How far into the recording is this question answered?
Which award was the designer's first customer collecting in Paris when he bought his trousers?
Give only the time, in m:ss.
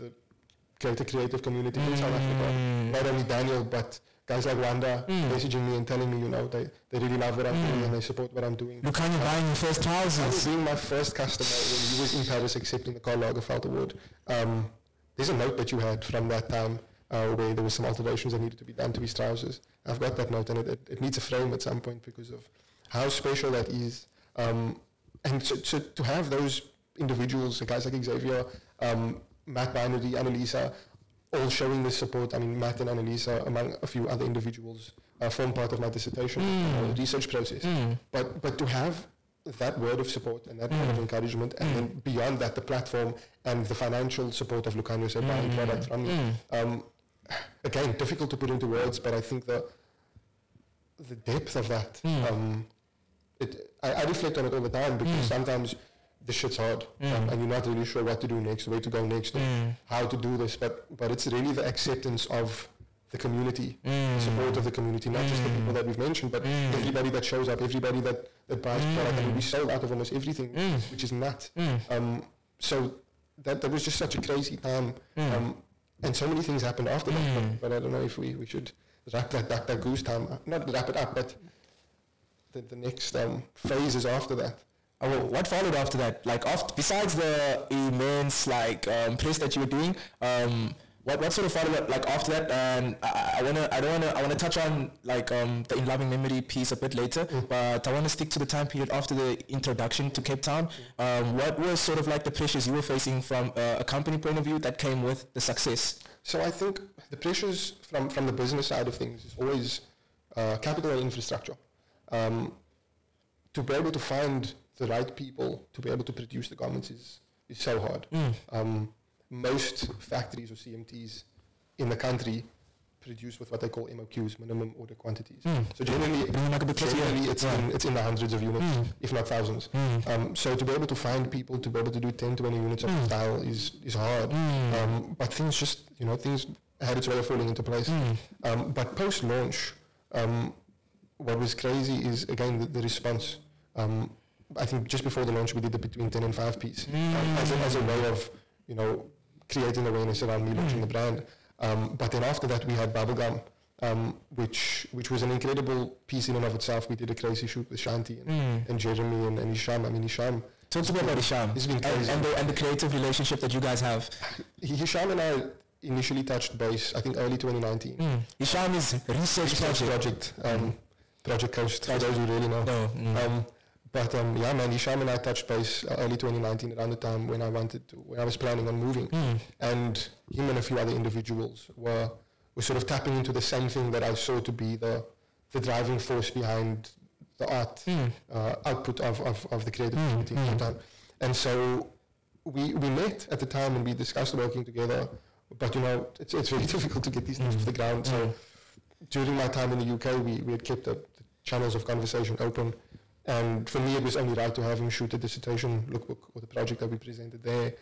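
0:12.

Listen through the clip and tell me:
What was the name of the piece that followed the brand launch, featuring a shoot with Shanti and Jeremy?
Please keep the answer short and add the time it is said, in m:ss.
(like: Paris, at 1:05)
bubblegum, at 2:32.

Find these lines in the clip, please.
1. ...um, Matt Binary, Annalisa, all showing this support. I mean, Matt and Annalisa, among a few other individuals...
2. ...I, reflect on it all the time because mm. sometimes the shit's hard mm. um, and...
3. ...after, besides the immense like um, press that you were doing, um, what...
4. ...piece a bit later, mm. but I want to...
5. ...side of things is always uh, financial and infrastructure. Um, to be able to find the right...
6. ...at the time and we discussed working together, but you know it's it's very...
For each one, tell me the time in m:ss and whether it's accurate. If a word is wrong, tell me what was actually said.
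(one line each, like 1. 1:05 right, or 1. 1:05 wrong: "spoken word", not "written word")
1. 0:28 right
2. 0:53 right
3. 1:26 right
4. 1:36 right
5. 1:48 wrong: "capital", not "financial"
6. 3:13 right.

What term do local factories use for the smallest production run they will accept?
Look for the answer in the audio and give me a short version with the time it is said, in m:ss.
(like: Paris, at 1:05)
minimum order quantities, at 2:04.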